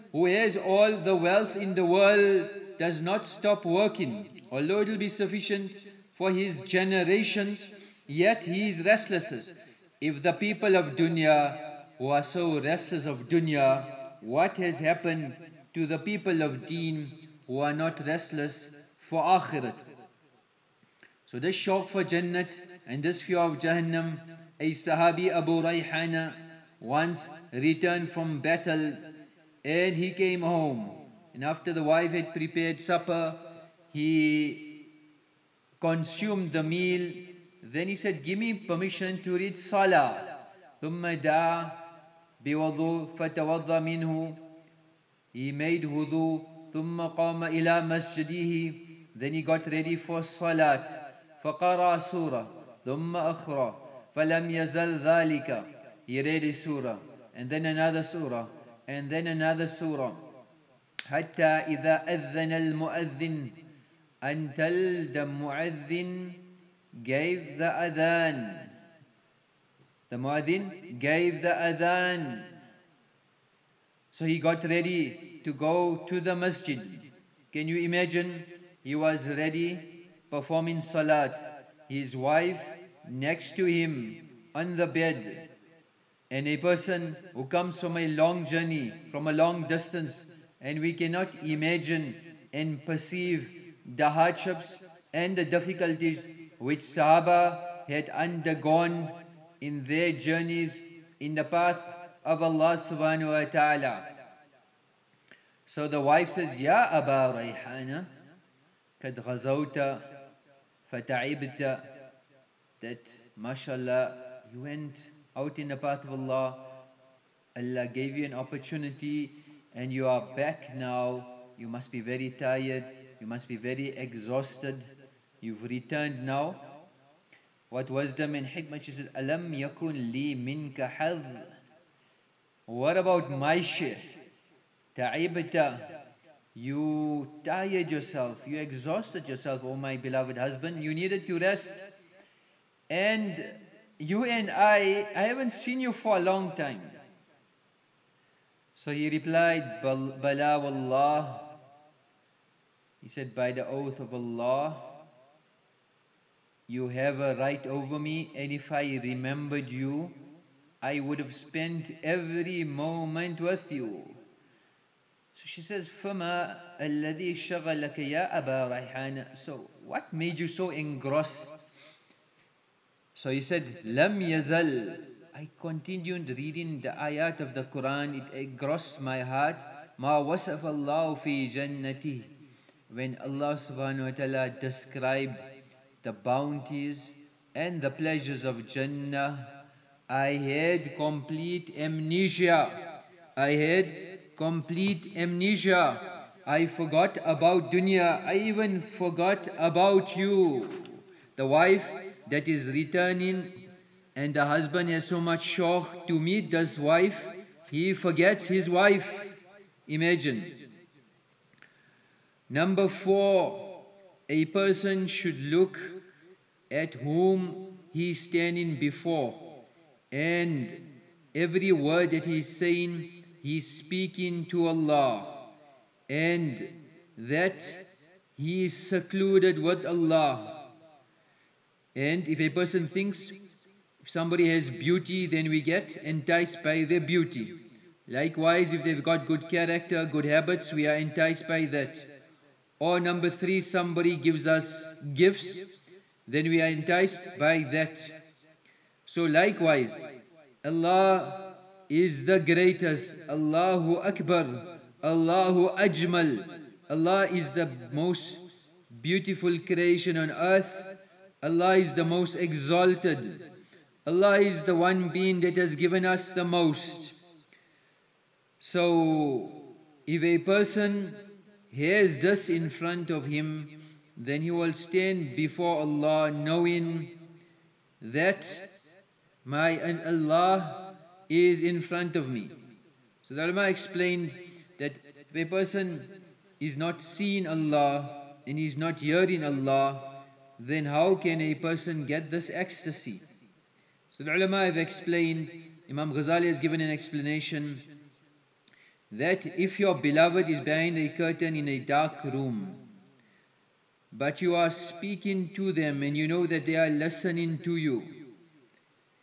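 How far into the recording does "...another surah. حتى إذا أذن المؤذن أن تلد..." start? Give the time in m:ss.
0:59.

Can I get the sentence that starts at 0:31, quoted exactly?
And after the wife had prepared supper, he consumed the meal then he said, Give me permission to read Salah.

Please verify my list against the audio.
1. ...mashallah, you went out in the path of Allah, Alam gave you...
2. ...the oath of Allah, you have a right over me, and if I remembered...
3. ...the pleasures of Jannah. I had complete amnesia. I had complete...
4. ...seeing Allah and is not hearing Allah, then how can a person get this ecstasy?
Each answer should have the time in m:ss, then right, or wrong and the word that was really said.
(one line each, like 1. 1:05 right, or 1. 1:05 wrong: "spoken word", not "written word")
1. 1:53 wrong: "Allah", not "Alam"
2. 2:33 right
3. 3:07 right
4. 4:47 right.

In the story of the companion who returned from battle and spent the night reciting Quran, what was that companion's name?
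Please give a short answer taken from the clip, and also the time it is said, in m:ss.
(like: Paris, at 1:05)
Abu Rayhana, at 0:25.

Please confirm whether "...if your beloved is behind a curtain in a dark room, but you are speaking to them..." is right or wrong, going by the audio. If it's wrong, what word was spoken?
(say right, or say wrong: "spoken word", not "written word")
right.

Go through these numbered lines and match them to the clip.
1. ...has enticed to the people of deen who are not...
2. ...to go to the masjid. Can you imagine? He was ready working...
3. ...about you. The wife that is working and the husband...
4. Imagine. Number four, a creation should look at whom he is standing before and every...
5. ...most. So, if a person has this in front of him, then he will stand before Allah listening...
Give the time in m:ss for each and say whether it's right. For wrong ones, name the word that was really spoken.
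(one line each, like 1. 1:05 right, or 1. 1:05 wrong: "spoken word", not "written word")
1. 0:14 wrong: "happened", not "enticed"
2. 1:15 wrong: "performing", not "working"
3. 3:19 wrong: "returning", not "working"
4. 3:29 wrong: "person", not "creation"
5. 4:26 wrong: "knowing", not "listening".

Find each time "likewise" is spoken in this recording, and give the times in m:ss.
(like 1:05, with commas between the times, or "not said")
3:58, 4:09.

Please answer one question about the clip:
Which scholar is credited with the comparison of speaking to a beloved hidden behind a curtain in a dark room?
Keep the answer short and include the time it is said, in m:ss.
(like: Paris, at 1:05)
Imam Ghazali, at 4:55.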